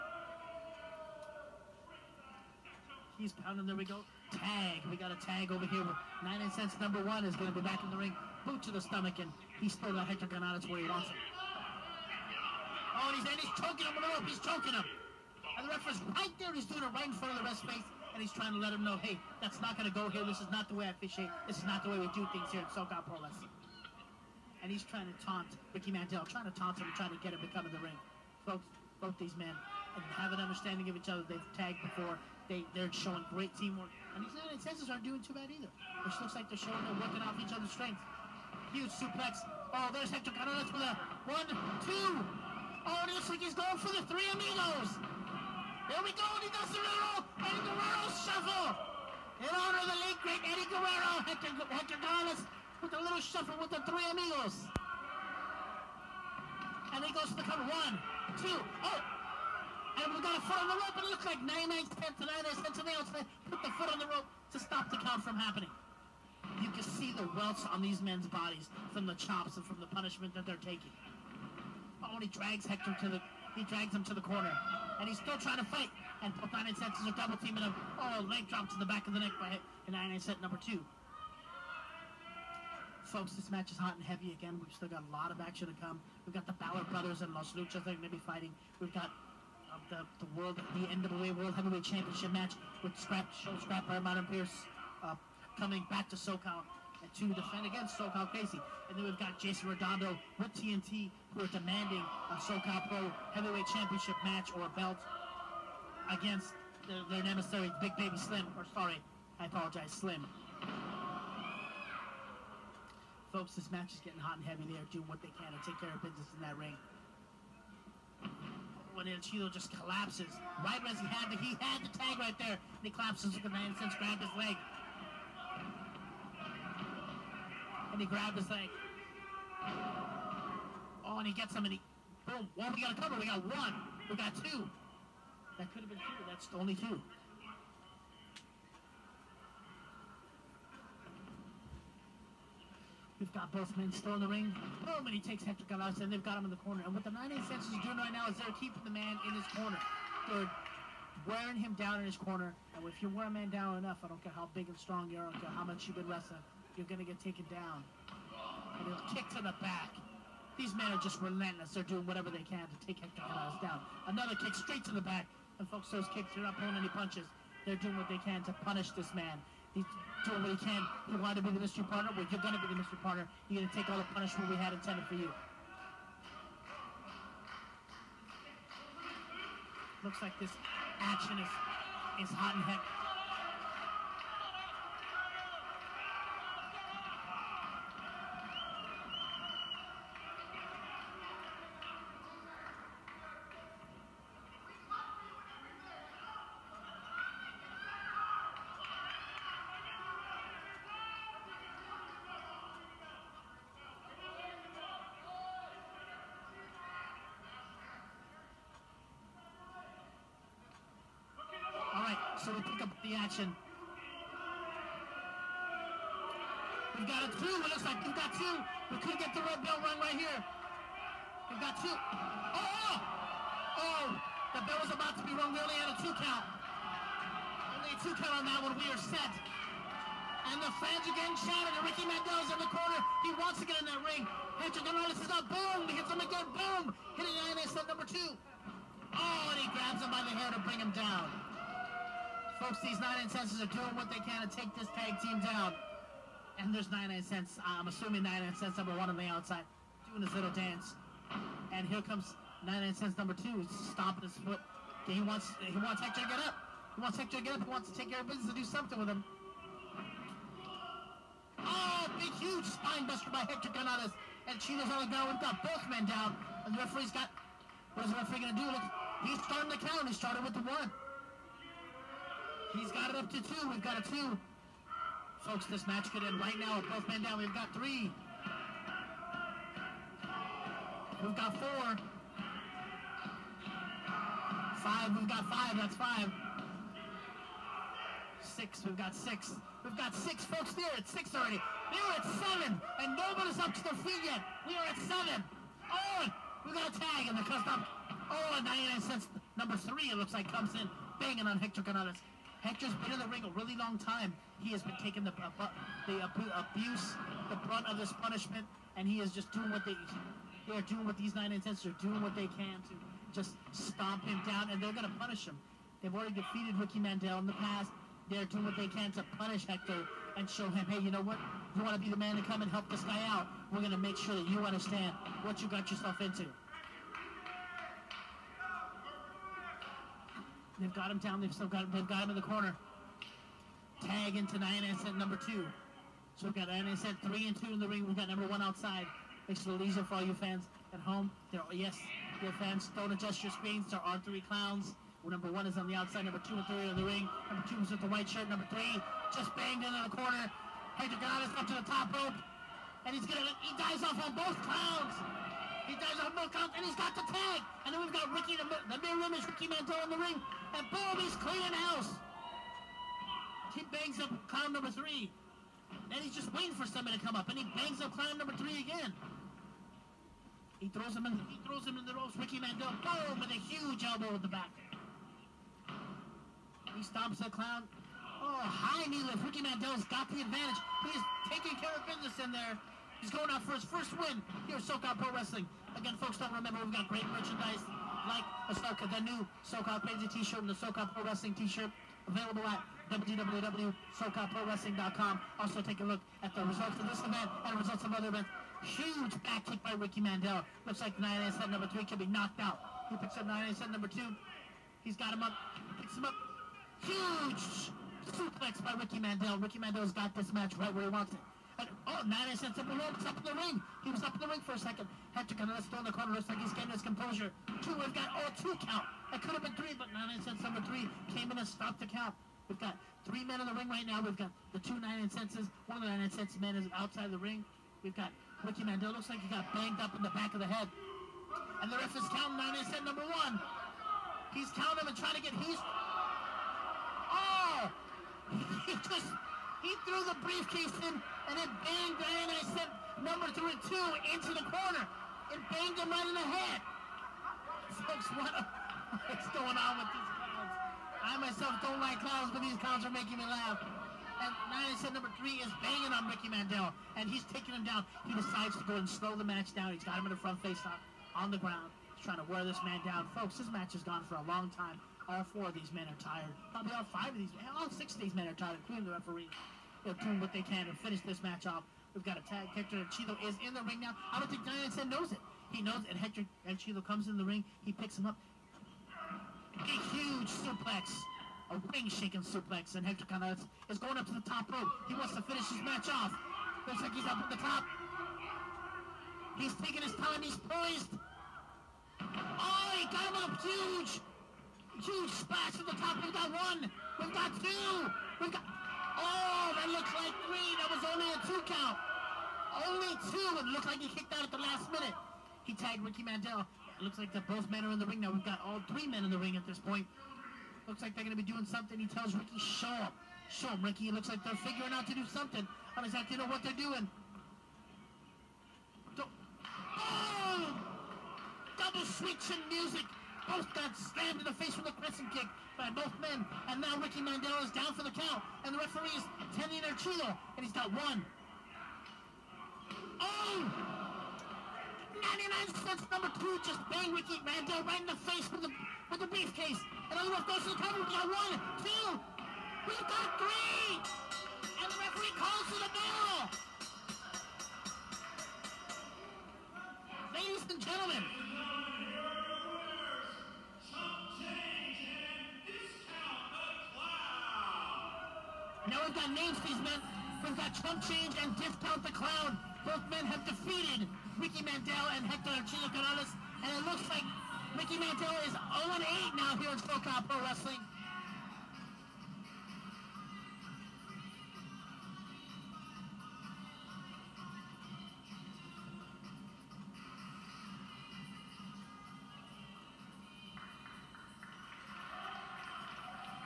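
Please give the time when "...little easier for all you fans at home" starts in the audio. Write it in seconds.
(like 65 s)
339 s.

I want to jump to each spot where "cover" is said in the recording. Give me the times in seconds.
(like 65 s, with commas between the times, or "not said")
57 s, 133 s, 540 s.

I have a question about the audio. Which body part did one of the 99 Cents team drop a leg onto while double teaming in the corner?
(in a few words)
Back of the neck.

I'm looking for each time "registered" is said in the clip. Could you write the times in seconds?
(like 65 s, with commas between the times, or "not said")
not said.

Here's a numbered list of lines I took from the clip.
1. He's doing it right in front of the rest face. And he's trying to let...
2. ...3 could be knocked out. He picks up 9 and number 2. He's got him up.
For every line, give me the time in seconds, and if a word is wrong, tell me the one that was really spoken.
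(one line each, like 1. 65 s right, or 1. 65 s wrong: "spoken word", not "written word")
1. 16 s right
2. 401 s right.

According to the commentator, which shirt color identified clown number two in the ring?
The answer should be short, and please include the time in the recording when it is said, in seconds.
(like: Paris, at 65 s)
White, at 347 s.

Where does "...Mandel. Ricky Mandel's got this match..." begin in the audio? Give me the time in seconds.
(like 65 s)
409 s.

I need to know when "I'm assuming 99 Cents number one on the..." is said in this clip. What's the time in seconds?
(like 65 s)
247 s.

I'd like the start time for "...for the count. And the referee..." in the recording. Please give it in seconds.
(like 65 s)
527 s.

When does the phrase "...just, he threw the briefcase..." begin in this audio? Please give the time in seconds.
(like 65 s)
439 s.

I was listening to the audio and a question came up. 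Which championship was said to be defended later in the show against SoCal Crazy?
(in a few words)
NWA World Heavyweight Championship.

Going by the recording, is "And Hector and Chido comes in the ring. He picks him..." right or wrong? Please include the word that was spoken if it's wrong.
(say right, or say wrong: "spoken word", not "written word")
right.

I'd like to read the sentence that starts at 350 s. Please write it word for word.
Pedro Ganadas up to the top rope.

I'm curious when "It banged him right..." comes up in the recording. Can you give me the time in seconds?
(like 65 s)
445 s.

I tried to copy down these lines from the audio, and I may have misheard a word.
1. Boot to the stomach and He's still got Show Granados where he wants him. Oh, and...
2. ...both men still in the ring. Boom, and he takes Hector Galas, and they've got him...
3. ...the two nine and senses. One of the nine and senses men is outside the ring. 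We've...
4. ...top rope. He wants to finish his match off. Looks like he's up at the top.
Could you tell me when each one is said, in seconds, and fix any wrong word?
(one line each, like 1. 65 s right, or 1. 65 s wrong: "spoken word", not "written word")
1. 8 s wrong: "Hector", not "Show"
2. 143 s right
3. 424 s right
4. 484 s right.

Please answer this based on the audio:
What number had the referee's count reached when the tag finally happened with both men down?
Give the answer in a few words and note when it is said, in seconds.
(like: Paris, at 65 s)
7, at 291 s.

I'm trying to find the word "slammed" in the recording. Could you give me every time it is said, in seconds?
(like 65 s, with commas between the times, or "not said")
523 s.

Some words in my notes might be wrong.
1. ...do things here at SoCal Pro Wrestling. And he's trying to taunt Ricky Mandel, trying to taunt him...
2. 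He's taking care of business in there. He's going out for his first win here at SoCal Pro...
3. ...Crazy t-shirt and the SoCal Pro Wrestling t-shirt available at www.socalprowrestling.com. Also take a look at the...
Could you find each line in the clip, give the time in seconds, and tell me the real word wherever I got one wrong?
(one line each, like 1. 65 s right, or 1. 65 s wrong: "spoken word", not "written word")
1. 22 s right
2. 381 s right
3. 390 s right.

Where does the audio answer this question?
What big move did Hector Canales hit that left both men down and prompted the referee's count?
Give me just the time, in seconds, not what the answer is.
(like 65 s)
262 s.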